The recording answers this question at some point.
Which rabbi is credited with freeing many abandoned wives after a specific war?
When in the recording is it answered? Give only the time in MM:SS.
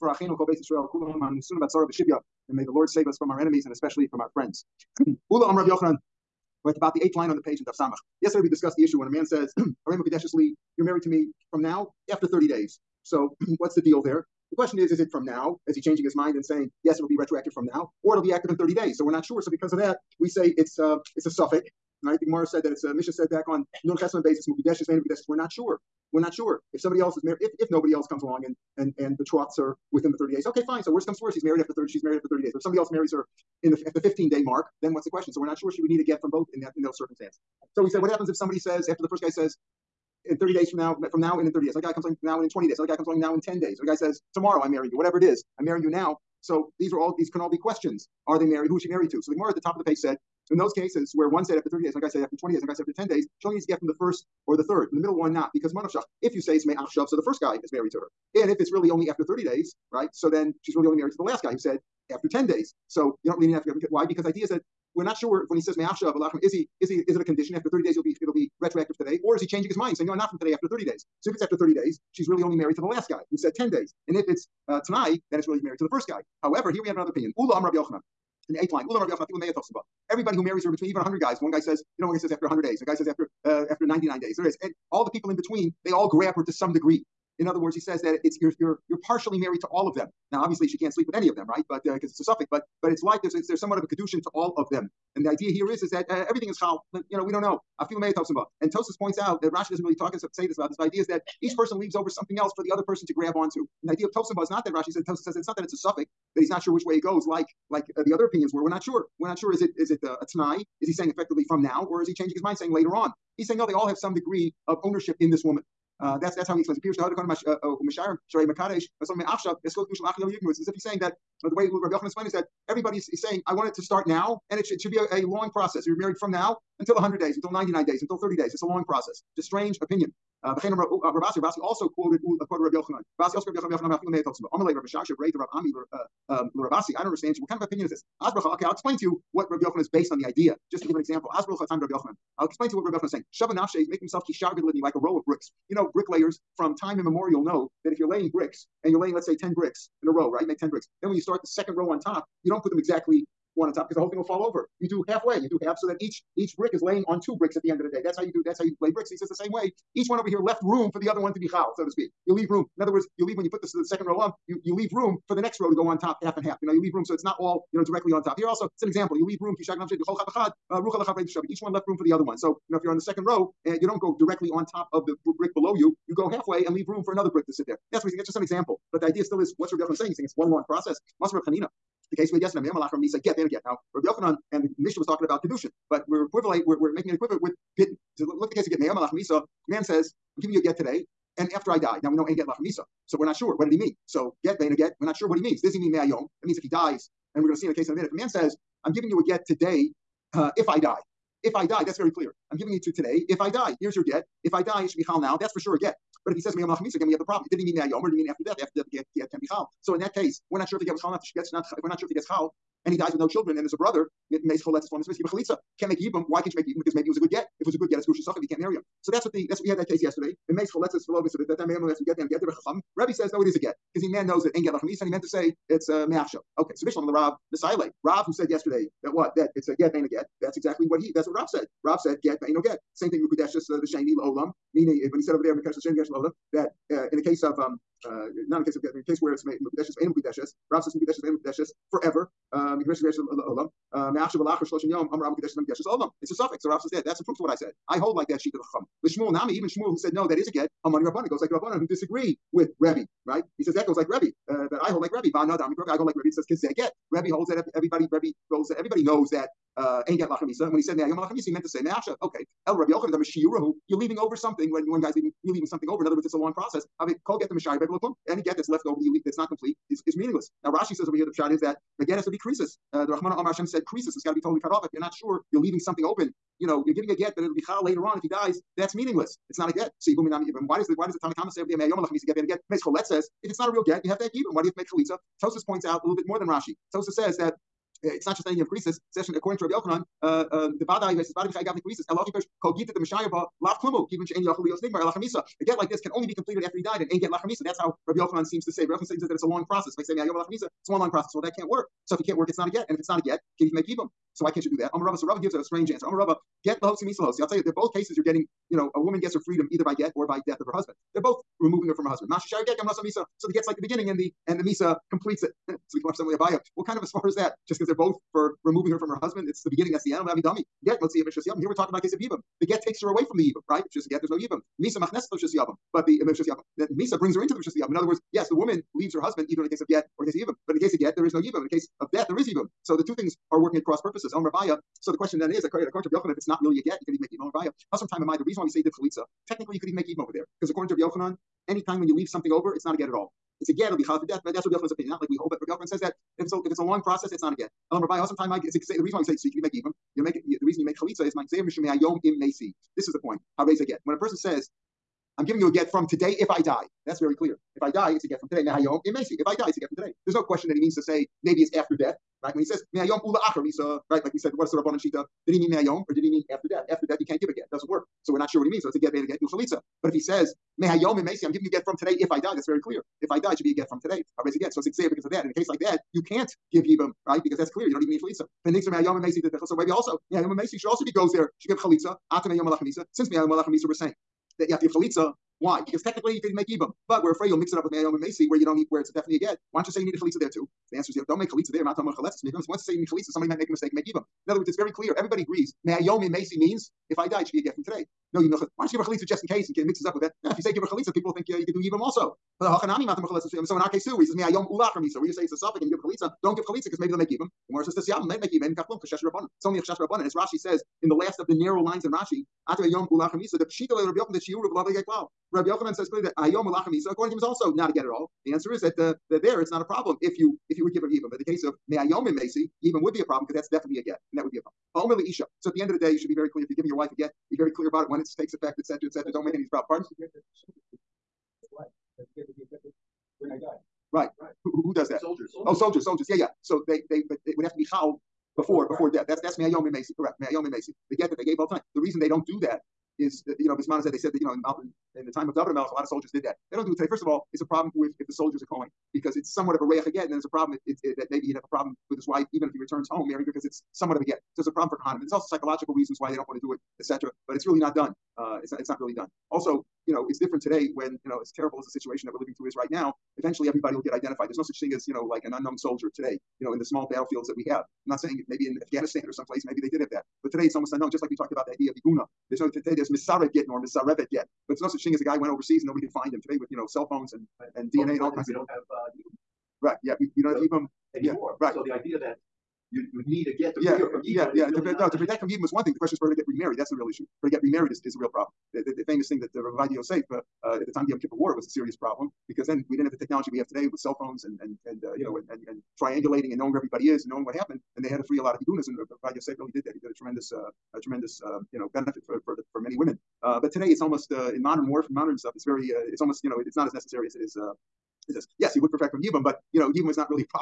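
08:09.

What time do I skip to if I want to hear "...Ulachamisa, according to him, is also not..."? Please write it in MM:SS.
06:56.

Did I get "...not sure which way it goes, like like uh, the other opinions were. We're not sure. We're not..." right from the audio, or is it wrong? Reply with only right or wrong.
right.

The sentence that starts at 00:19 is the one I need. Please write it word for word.
So because of that, we say it's uh, it's a suffix.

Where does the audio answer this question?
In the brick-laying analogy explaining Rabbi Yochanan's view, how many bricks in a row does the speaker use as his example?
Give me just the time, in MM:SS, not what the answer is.
02:29.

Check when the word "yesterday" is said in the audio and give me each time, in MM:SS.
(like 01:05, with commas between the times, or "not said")
00:08, 03:02, 03:40, 03:48.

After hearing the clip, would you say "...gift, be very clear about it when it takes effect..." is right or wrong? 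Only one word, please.
right.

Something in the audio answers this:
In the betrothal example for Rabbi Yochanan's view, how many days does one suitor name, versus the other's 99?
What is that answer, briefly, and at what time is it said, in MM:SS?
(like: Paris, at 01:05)
100, at 01:22.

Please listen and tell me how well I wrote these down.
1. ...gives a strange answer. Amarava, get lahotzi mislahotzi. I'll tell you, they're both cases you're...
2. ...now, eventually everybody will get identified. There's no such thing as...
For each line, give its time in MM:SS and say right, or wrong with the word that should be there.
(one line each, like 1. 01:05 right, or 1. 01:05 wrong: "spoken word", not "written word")
1. 05:05 right
2. 07:42 right.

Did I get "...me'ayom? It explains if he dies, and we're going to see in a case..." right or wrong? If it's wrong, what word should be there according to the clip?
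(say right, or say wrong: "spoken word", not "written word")
wrong: "means", not "explains".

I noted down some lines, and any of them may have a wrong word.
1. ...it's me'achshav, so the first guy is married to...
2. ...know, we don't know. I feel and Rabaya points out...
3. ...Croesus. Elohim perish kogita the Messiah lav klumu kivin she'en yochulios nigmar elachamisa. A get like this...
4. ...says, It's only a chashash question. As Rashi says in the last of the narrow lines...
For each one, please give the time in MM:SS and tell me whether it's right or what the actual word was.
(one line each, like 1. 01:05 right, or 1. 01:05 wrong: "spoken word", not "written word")
1. 00:56 right
2. 01:37 wrong: "Tosis", not "Rabaya"
3. 04:51 right
4. 06:47 wrong: "rabbanon", not "question".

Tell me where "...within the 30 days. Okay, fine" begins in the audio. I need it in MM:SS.
00:29.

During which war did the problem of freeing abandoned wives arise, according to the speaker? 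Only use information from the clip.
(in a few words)
Yom Kippur War.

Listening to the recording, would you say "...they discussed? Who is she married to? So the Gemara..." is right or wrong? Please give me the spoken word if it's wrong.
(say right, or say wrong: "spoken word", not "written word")
wrong: "married", not "discussed".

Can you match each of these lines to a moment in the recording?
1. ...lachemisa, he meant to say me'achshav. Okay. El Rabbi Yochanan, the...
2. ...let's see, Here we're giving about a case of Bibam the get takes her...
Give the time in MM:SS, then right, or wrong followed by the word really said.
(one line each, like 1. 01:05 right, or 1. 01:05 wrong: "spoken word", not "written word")
1. 04:21 right
2. 05:21 wrong: "talking", not "giving".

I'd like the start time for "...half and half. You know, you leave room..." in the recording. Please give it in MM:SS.
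02:46.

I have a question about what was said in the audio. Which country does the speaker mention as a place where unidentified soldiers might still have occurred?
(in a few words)
Afghanistan.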